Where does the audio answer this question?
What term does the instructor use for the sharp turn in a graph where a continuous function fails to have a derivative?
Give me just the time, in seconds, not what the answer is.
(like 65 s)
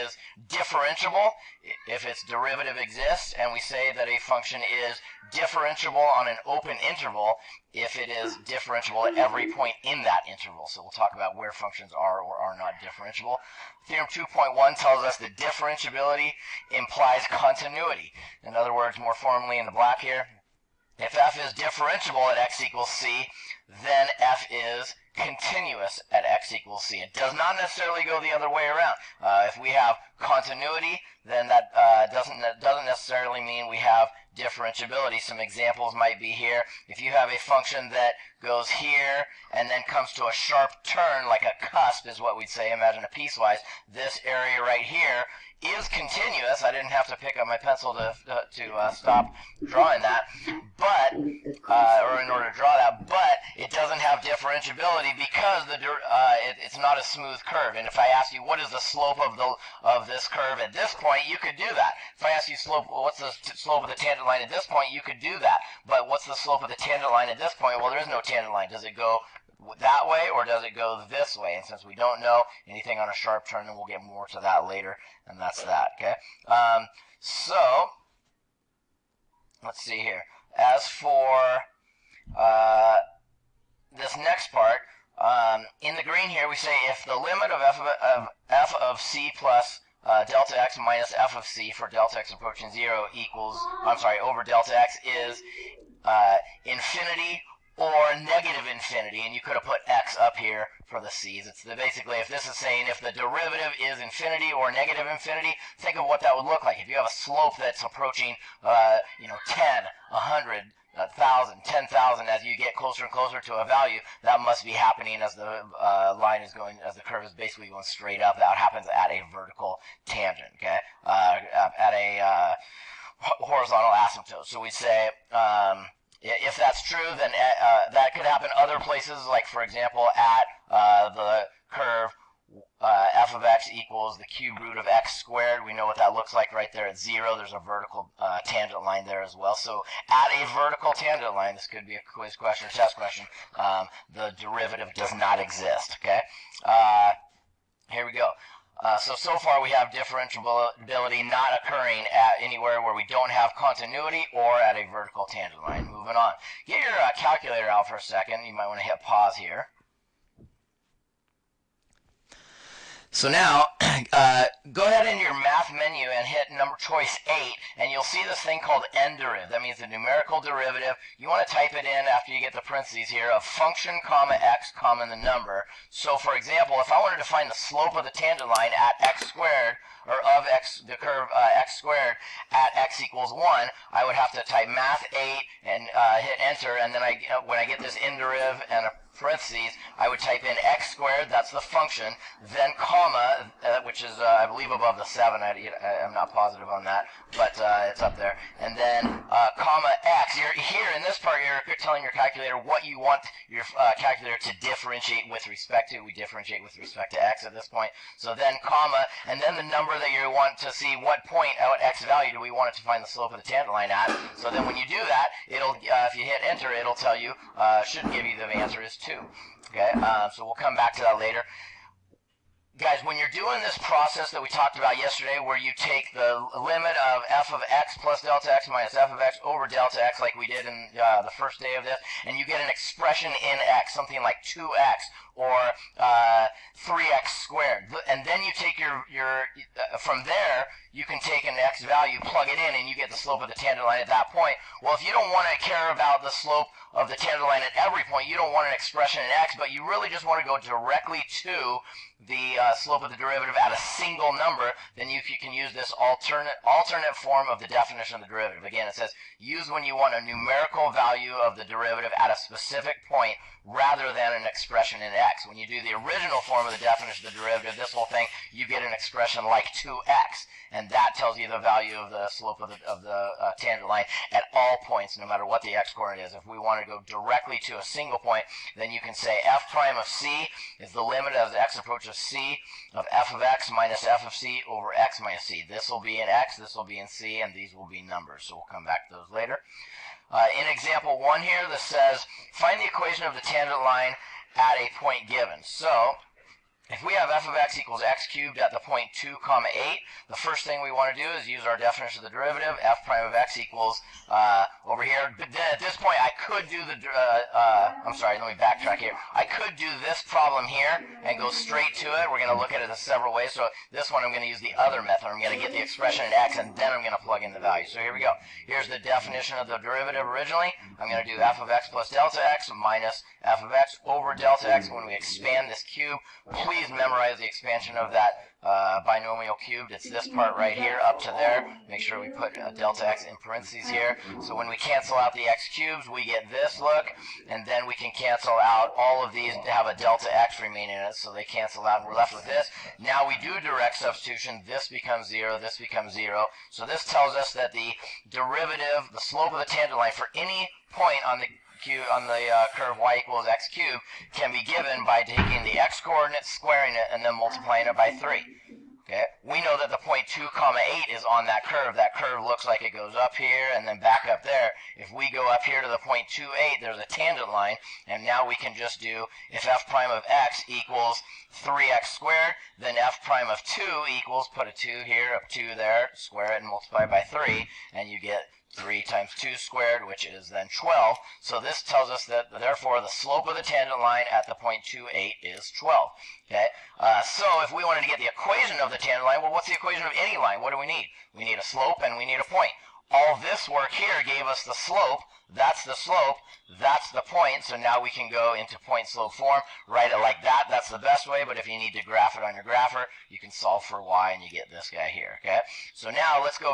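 41 s.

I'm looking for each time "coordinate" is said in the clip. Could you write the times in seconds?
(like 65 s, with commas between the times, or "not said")
275 s, 356 s.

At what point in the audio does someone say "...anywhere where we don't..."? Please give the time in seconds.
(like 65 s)
152 s.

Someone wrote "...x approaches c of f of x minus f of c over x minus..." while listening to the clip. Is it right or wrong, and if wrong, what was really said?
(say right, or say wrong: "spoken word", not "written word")
right.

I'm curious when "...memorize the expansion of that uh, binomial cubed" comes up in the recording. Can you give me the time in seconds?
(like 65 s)
326 s.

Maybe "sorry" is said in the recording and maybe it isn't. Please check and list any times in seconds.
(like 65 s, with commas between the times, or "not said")
93 s, 308 s.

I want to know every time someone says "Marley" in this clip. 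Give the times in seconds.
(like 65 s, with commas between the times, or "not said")
not said.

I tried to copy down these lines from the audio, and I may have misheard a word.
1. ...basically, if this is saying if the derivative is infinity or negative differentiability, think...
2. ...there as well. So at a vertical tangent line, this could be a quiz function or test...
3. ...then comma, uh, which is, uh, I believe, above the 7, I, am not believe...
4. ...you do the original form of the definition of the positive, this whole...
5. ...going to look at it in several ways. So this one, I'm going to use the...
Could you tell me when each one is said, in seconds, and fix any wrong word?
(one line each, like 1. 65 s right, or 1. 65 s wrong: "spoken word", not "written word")
1. 101 s wrong: "infinity", not "differentiability"
2. 139 s wrong: "question", not "function"
3. 192 s wrong: "positive", not "believe"
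4. 265 s wrong: "derivative", not "positive"
5. 312 s right.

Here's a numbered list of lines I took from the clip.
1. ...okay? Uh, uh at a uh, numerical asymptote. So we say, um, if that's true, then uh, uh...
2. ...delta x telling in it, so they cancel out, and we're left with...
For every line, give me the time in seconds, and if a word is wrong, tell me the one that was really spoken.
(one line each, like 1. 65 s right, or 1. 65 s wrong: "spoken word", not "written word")
1. 120 s wrong: "horizontal", not "numerical"
2. 339 s wrong: "remaining", not "telling".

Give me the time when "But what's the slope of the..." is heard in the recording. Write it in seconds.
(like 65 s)
65 s.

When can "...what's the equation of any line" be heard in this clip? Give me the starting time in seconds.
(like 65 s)
389 s.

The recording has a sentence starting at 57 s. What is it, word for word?
And if I ask you what is the slope of the of this curve at this point, you could do that.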